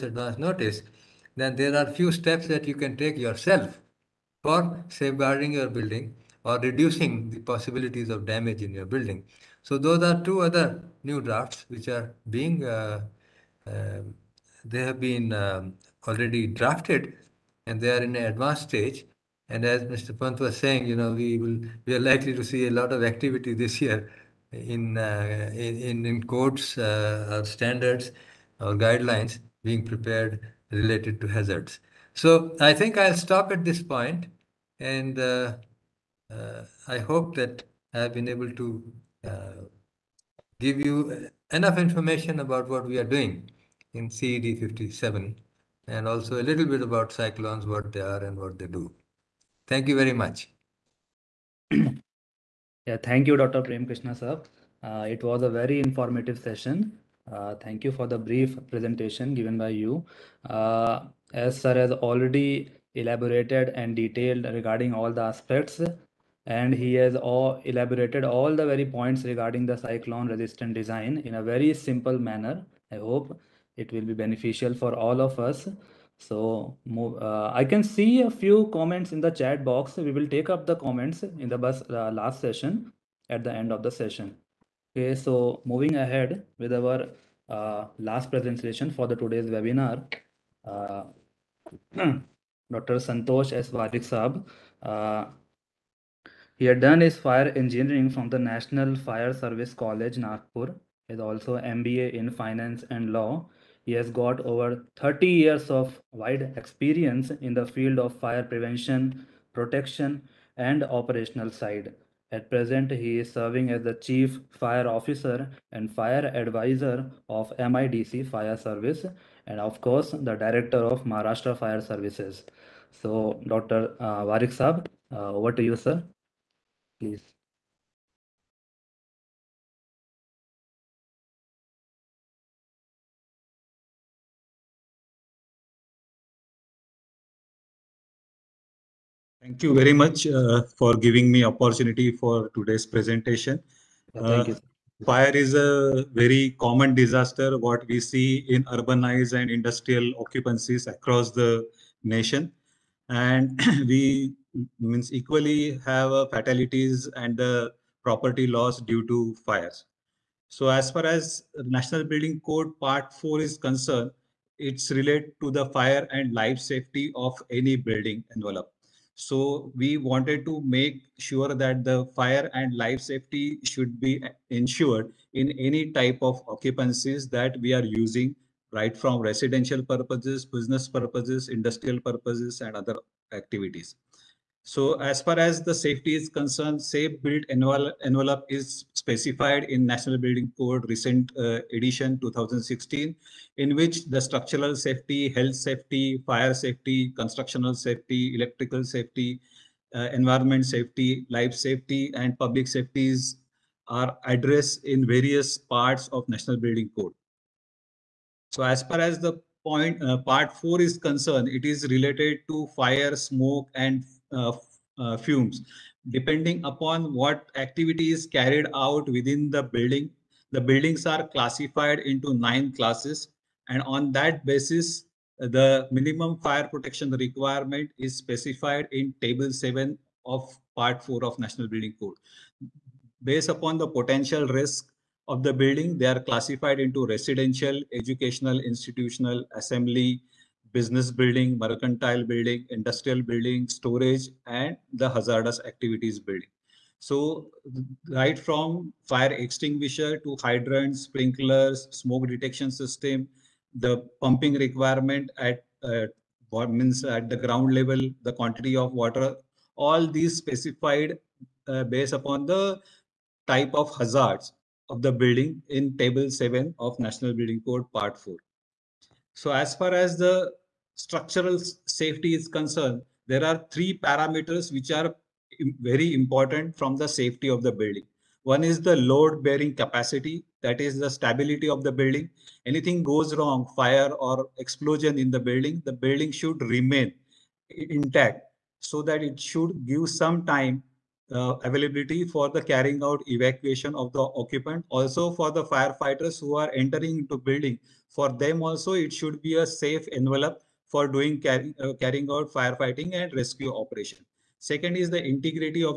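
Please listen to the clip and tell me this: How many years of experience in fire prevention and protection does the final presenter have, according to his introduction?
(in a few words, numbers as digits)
Over 30.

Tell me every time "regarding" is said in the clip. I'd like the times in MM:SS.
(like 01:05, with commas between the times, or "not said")
01:04, 01:09.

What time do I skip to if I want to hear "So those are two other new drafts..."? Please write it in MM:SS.
00:09.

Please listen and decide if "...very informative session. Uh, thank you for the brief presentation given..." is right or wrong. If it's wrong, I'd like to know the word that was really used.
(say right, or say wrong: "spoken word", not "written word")
right.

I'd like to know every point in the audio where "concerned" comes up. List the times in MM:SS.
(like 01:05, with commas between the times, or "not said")
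02:43, 03:06, 03:30, 04:32.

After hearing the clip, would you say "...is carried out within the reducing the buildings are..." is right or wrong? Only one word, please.
wrong.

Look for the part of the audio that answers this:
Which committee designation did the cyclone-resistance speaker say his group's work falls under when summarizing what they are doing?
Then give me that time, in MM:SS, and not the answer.
00:44.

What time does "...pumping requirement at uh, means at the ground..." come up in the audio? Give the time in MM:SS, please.
04:14.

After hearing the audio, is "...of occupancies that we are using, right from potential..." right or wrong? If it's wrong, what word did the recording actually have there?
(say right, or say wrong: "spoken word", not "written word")
wrong: "residential", not "potential".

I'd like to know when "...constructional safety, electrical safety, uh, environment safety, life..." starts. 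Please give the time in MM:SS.
03:17.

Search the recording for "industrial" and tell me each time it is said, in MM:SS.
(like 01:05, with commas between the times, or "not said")
02:29, 03:01, 04:02.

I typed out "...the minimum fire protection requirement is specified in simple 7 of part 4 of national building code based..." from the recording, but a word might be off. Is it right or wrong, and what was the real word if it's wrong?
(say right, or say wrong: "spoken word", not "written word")
wrong: "table", not "simple".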